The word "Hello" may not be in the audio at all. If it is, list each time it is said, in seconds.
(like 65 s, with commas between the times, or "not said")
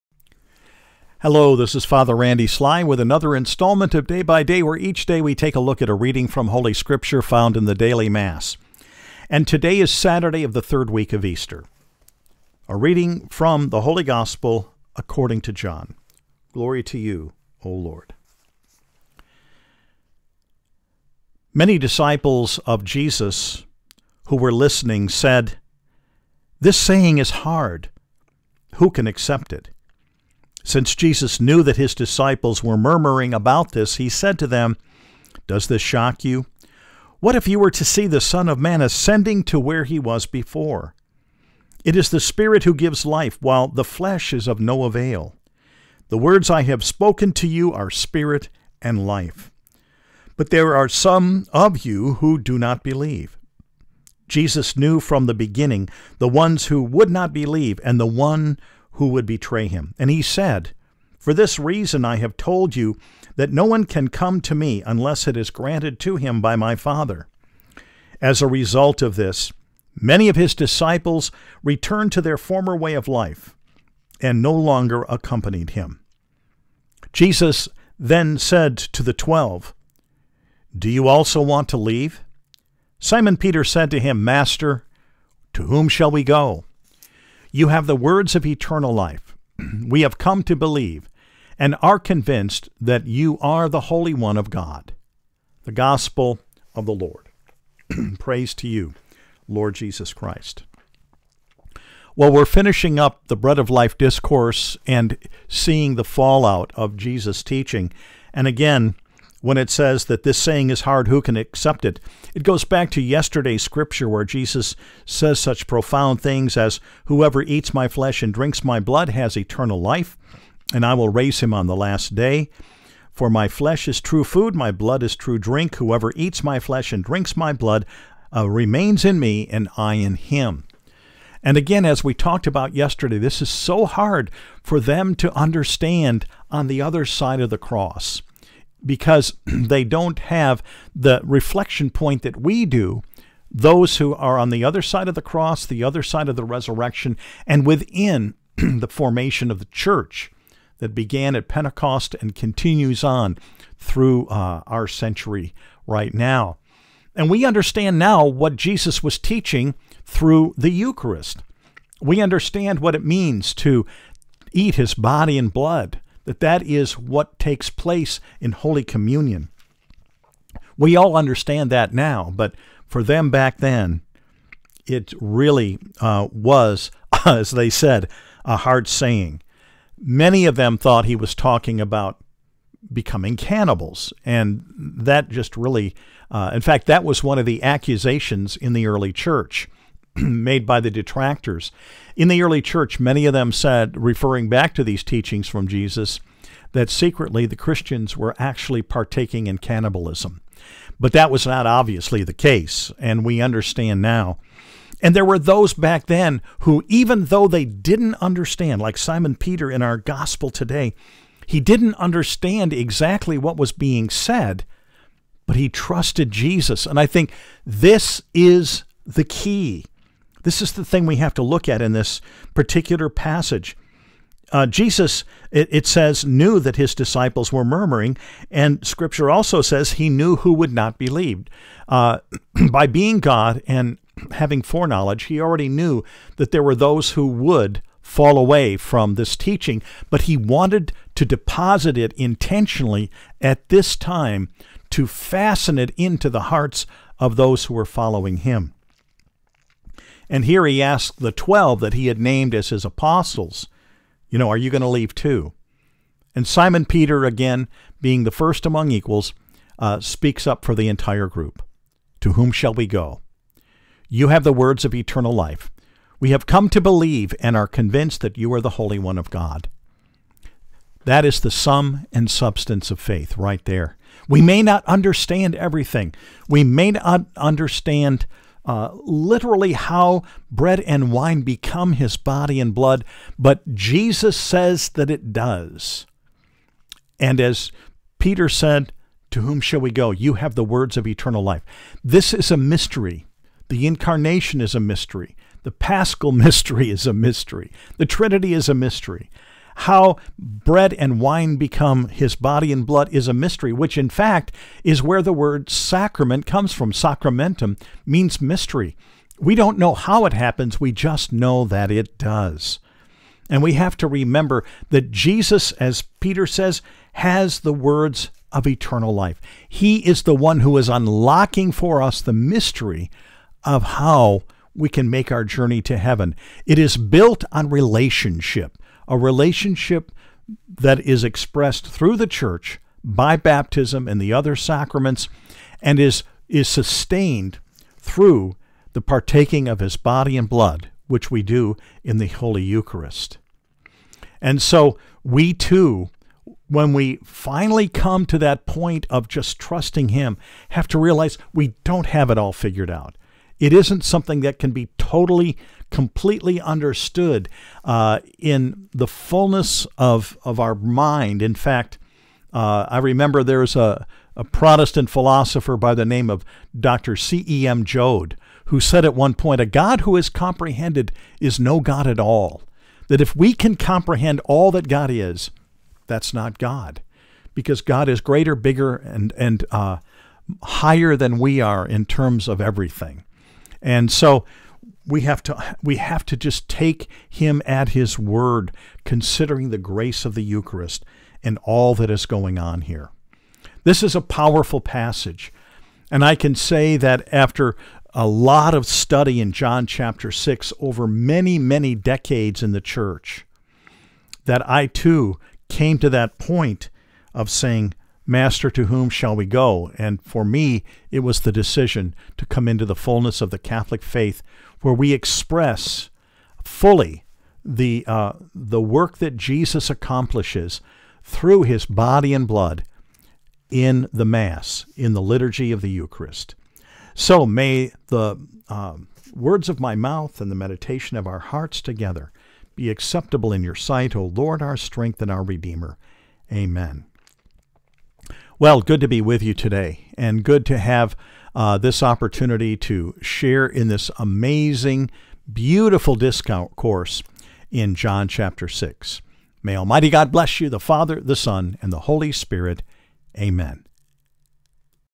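1 s.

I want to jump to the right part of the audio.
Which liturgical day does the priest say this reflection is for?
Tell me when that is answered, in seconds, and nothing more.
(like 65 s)
9 s.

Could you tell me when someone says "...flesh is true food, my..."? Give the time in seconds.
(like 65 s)
123 s.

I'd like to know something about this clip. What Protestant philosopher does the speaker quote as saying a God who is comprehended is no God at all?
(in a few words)
Dr. C.E.M. Joad.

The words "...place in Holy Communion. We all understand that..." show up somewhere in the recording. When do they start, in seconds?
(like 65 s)
167 s.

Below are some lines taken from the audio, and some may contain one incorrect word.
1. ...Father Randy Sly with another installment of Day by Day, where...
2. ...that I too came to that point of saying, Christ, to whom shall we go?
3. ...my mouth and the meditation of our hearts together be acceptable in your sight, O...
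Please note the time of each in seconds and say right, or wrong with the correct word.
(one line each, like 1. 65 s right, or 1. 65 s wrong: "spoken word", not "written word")
1. 1 s right
2. 404 s wrong: "Master", not "Christ"
3. 429 s right.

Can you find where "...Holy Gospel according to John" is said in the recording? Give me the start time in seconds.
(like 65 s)
13 s.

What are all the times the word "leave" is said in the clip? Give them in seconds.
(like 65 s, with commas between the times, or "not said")
81 s, 254 s.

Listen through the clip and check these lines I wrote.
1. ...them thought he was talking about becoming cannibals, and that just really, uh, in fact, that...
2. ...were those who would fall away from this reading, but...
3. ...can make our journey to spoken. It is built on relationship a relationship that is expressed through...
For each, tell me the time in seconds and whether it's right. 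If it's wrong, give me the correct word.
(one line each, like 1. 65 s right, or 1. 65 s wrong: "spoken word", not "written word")
1. 180 s right
2. 236 s wrong: "teaching", not "reading"
3. 324 s wrong: "heaven", not "spoken".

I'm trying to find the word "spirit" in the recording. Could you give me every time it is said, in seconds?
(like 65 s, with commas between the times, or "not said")
42 s, 47 s, 452 s.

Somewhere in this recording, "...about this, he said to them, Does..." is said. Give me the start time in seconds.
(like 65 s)
33 s.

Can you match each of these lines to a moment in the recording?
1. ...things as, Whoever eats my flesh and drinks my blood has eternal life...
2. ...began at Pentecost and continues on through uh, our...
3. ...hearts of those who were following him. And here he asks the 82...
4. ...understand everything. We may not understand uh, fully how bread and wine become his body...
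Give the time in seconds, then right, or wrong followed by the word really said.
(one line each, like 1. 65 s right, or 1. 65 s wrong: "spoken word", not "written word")
1. 116 s right
2. 150 s right
3. 246 s wrong: "12", not "82"
4. 274 s wrong: "literally", not "fully".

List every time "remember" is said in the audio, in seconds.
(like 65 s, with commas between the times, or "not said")
314 s, 362 s.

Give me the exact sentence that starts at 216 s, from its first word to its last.
And I think this is the key this is the thing we have to look at in this particular passage.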